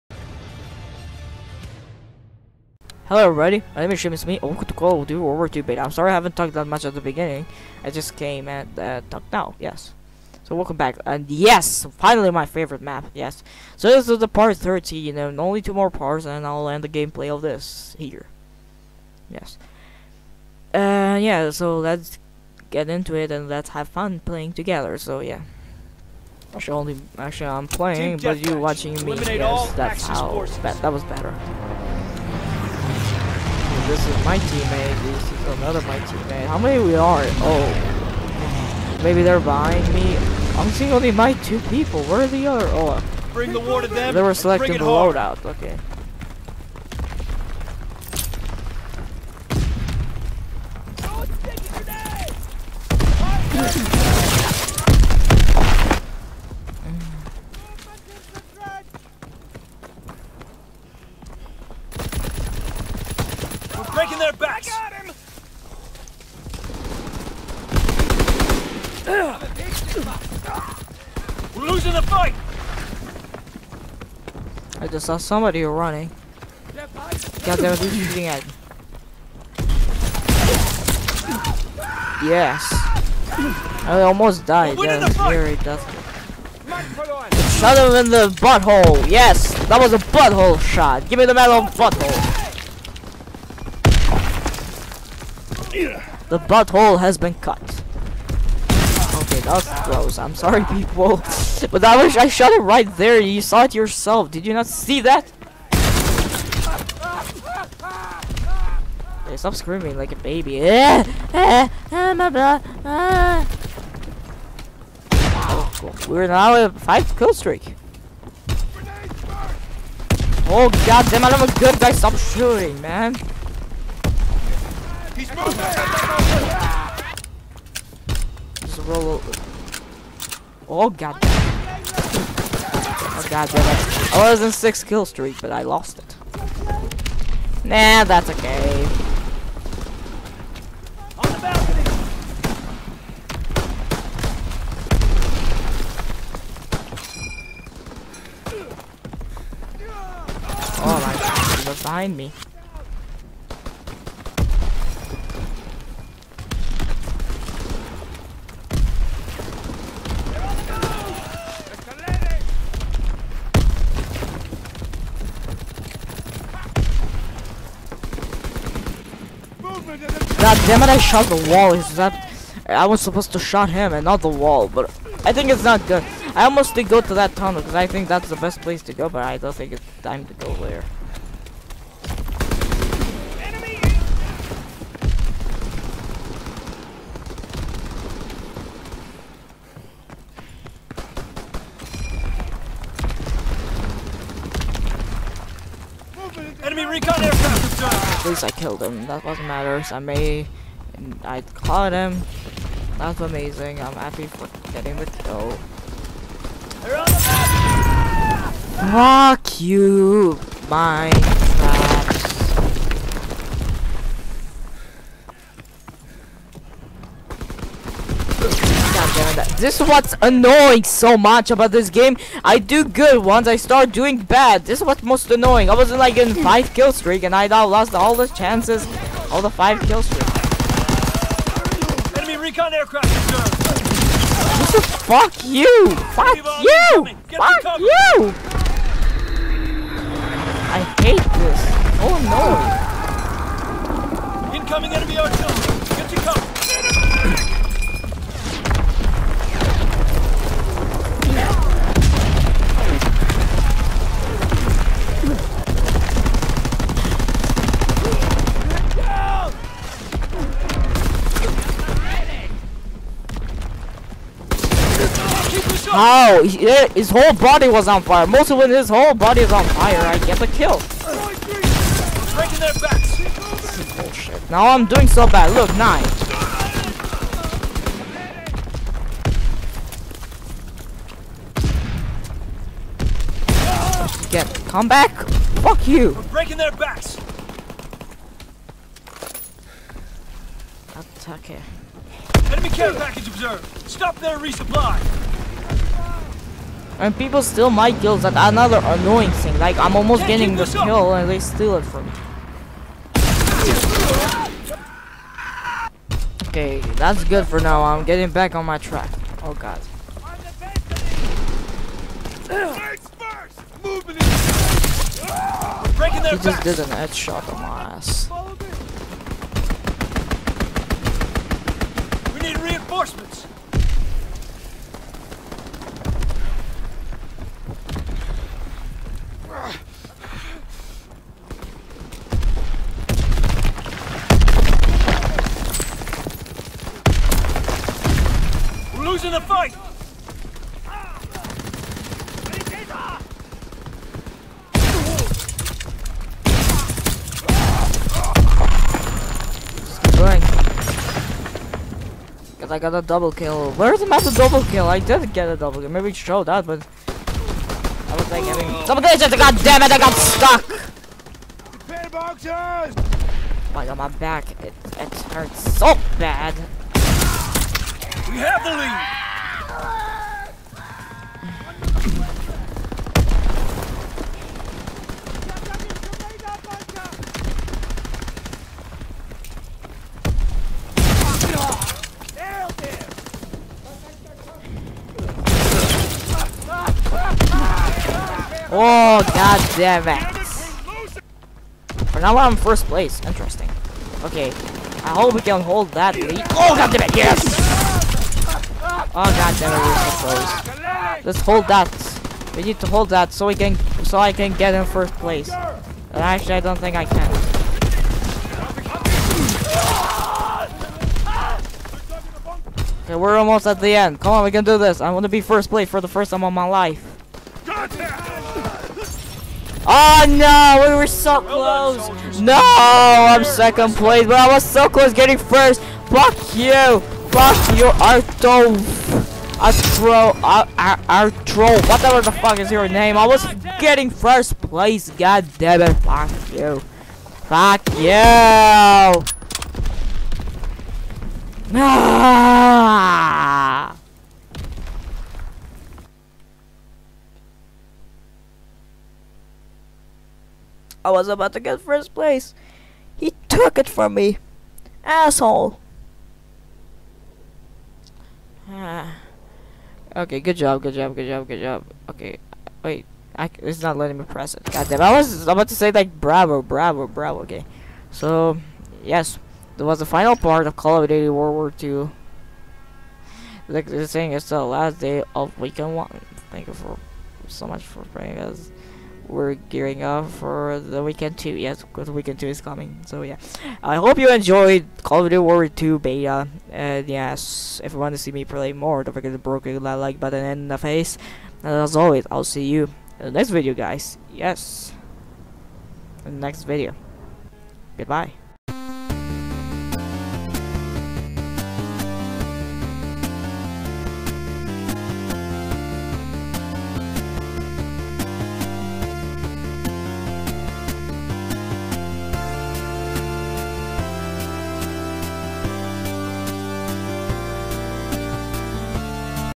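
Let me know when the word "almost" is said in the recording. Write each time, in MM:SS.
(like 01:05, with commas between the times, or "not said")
01:24, 02:56, 04:59, 06:53.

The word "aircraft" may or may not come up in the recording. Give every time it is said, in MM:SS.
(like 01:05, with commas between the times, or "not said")
03:17, 03:52.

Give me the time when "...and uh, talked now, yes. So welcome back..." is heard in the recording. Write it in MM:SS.
00:08.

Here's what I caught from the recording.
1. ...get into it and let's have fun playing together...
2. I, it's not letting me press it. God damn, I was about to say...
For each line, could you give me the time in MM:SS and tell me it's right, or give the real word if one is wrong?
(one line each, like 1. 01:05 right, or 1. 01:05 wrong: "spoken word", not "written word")
1. 00:22 right
2. 07:43 right.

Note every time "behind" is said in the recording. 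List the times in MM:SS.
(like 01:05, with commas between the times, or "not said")
00:39, 02:31.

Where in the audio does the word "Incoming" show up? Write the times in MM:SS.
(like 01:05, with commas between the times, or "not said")
04:04.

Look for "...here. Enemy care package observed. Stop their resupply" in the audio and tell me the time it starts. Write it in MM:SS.
04:51.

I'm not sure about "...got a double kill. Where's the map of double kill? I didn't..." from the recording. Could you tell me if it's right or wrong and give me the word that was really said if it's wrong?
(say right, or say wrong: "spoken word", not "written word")
right.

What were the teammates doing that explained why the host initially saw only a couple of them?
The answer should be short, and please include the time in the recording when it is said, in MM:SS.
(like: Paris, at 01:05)
Selecting the loadout, at 00:44.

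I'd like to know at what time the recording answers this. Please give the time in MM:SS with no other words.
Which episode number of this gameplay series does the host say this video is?
00:14.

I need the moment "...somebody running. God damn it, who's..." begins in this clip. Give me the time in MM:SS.
01:15.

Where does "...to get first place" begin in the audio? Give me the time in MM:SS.
07:31.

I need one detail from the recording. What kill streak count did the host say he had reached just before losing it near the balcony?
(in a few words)
6.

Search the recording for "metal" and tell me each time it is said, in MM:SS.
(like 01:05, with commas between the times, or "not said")
01:31.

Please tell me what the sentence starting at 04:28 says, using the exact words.
Most of it, his whole body is on fire.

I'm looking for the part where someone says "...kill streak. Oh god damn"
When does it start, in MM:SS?
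01:57.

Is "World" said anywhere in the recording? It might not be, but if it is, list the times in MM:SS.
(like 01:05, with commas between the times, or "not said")
00:05, 07:51.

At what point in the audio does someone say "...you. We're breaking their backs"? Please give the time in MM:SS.
04:45.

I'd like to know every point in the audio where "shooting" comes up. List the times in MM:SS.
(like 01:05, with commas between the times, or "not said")
01:18, 02:02.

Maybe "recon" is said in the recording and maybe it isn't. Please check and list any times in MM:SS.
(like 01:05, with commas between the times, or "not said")
03:16, 03:52.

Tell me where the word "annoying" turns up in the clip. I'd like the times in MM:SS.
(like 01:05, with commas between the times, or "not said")
03:40, 03:45, 04:58.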